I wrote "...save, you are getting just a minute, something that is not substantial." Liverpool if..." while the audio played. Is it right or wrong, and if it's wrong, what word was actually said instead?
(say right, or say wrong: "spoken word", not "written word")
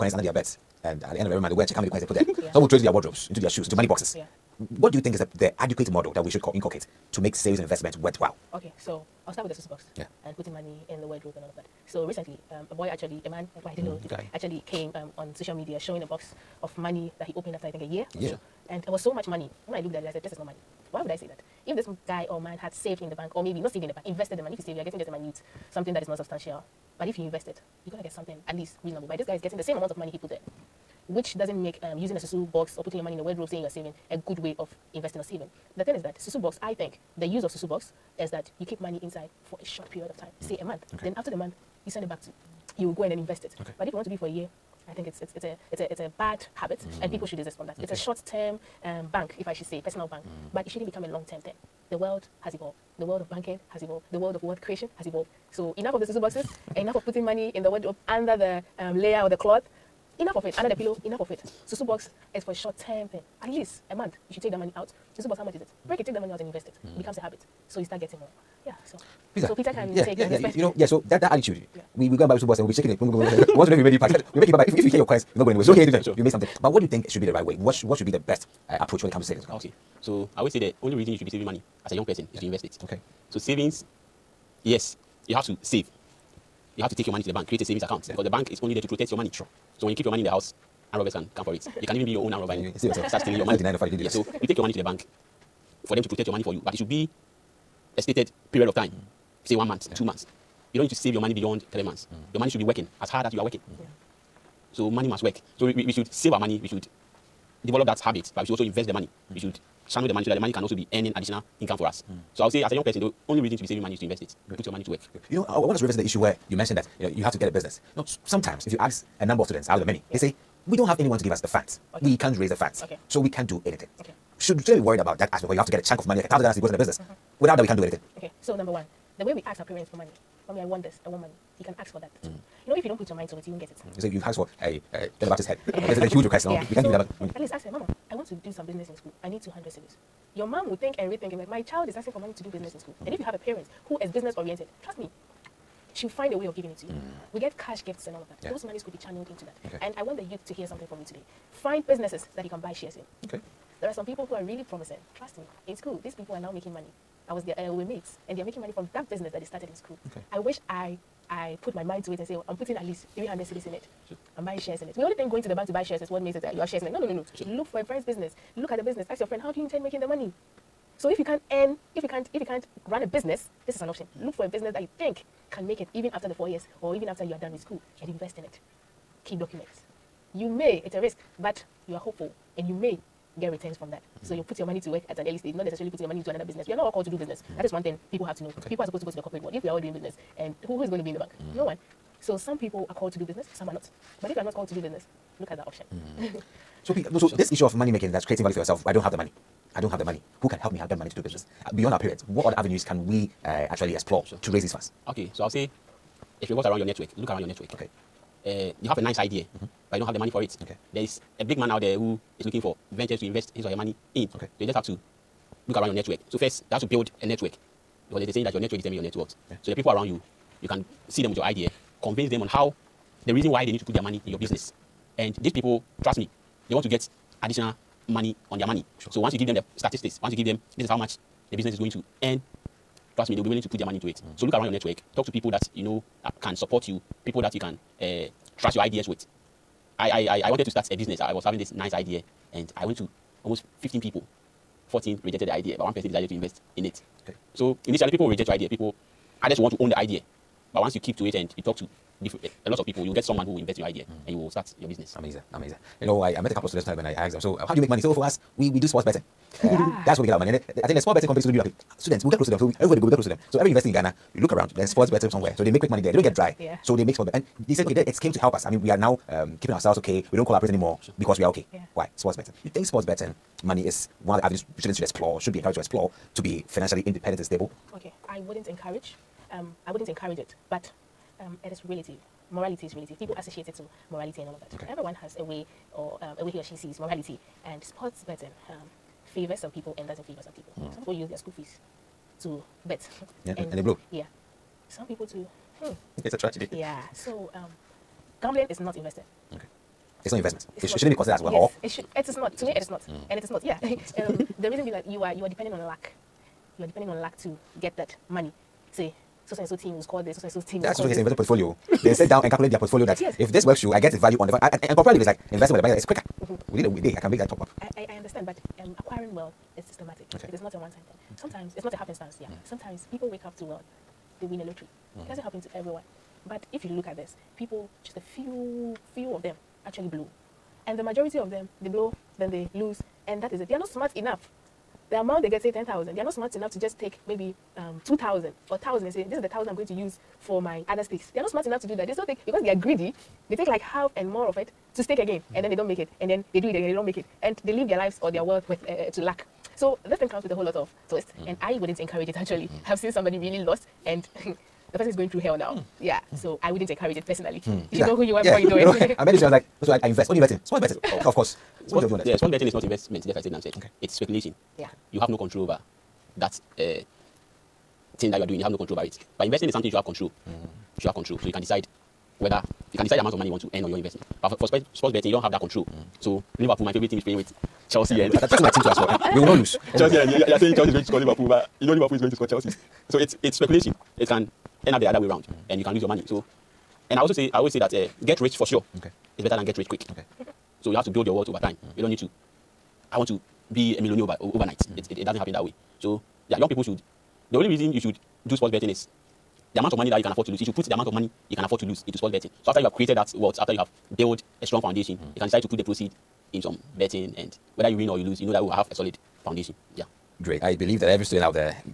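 wrong: "But", not "Liverpool".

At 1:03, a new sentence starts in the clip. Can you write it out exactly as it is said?
At least a month, you should take that money out.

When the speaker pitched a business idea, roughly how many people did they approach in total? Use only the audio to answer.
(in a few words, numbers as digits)
15.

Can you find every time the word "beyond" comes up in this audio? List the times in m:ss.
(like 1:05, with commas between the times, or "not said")
1:41, 3:21.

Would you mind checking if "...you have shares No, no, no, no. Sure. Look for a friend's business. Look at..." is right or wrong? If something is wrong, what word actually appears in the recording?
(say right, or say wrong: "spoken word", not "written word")
right.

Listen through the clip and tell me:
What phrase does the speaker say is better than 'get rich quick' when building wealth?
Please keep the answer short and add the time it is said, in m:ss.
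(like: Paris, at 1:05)
get rich for sure, at 6:28.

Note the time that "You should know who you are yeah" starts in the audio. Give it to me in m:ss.
5:57.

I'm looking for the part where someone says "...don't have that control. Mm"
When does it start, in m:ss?
6:15.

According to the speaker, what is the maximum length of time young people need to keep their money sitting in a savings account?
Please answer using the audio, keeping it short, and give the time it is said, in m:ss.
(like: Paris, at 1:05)
3 months, at 1:41.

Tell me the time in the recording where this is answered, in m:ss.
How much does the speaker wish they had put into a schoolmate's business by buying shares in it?
2:43.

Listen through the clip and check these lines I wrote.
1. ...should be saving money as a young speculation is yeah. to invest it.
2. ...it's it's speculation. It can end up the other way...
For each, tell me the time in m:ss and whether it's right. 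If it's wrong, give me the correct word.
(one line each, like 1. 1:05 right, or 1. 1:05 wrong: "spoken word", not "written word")
1. 1:21 wrong: "person", not "speculation"
2. 6:23 right.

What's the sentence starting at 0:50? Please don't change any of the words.
but it shouldn't become a long term thing.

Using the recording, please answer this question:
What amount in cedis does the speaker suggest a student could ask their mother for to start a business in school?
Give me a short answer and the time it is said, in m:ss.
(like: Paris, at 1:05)
200 cedis, at 2:19.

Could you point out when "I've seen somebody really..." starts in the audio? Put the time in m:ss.
5:52.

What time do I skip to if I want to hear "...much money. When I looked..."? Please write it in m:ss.
0:19.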